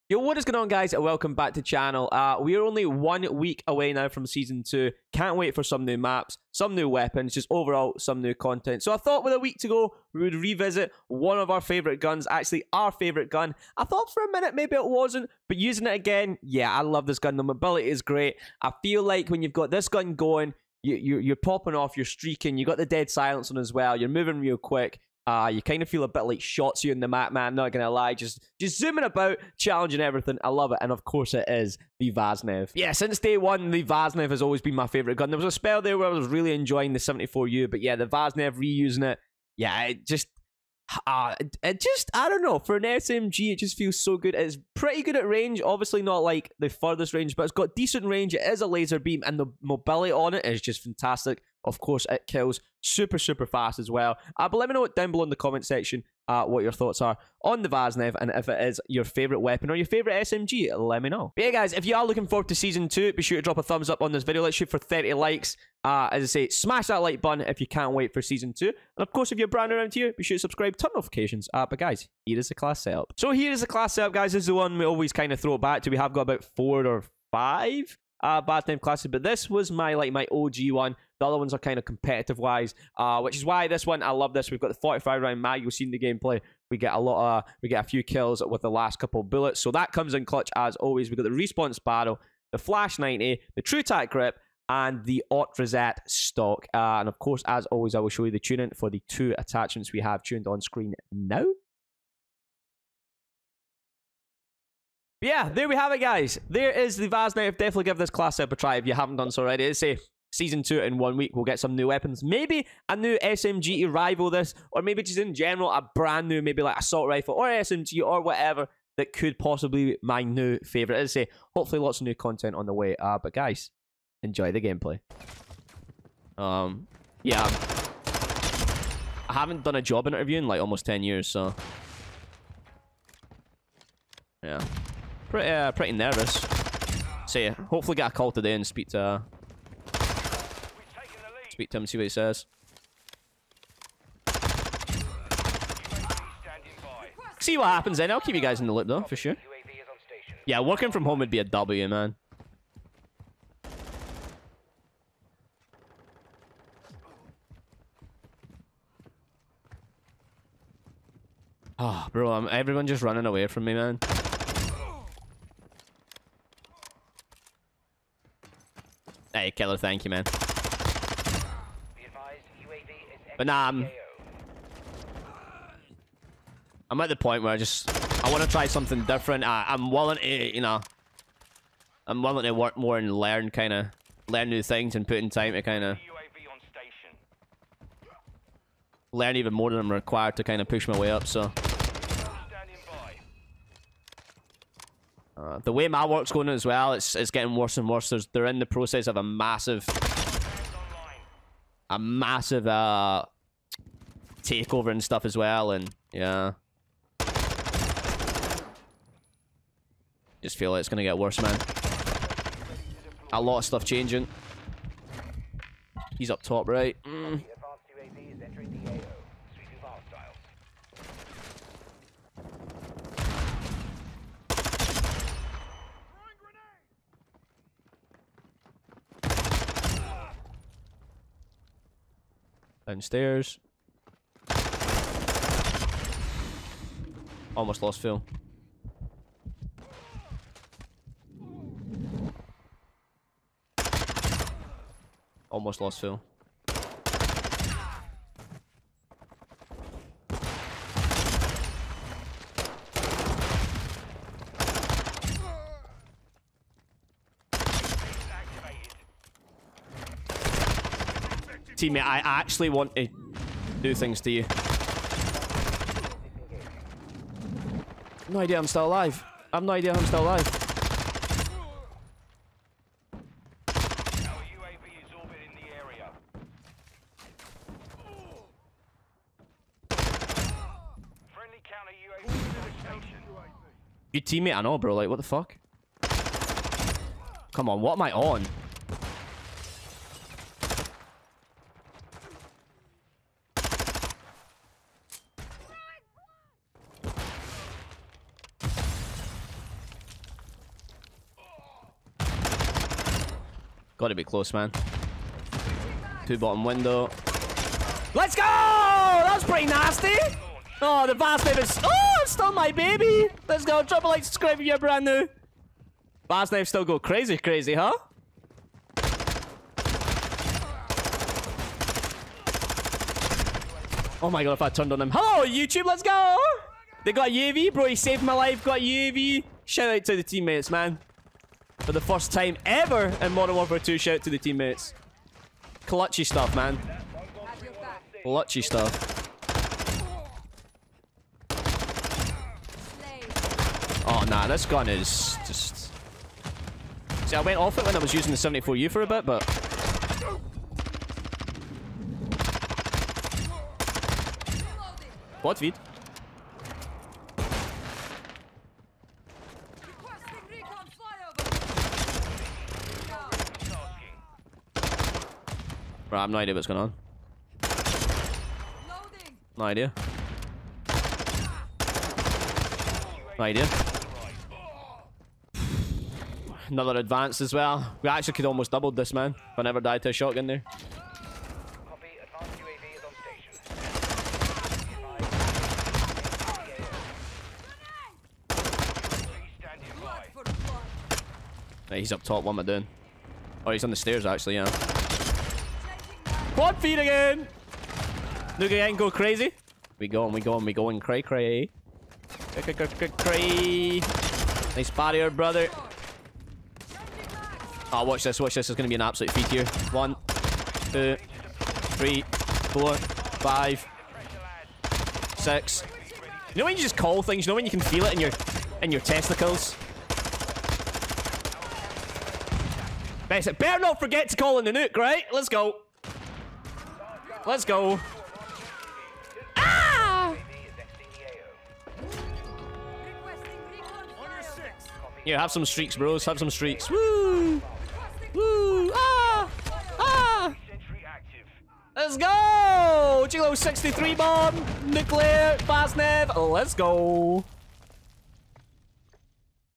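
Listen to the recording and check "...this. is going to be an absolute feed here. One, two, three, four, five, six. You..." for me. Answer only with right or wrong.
right.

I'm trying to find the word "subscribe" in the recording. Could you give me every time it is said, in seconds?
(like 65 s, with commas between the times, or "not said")
70 s, 314 s.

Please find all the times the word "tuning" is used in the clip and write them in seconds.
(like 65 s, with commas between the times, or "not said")
98 s.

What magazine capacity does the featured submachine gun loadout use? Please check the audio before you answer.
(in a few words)
45 round.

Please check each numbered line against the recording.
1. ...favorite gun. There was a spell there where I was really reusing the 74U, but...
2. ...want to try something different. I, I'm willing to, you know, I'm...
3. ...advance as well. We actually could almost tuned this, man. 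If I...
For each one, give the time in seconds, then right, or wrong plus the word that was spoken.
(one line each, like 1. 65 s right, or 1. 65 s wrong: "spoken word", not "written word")
1. 34 s wrong: "enjoying", not "reusing"
2. 178 s right
3. 376 s wrong: "doubled", not "tuned".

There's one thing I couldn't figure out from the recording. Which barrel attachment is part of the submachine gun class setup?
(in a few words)
Response barrel.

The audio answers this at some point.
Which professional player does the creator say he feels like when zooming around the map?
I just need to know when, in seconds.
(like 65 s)
26 s.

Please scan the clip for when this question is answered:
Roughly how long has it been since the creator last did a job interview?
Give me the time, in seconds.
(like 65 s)
130 s.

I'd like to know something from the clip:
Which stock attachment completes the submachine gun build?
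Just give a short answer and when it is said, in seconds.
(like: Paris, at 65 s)
Ot Reset stock, at 95 s.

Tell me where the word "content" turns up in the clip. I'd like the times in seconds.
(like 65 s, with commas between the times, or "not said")
8 s, 122 s.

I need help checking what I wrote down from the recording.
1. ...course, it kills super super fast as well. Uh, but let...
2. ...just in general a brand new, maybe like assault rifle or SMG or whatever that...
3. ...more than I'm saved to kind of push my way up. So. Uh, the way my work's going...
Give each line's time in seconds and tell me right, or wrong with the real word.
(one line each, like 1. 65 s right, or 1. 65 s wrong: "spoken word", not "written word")
1. 51 s right
2. 115 s right
3. 189 s wrong: "required", not "saved".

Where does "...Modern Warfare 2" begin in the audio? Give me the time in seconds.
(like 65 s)
333 s.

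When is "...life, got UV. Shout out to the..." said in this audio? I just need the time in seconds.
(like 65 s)
328 s.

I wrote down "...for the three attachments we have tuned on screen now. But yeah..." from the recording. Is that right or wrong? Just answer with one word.
wrong.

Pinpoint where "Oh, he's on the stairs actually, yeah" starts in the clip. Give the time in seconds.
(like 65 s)
393 s.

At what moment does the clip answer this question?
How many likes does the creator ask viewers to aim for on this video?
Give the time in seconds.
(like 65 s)
64 s.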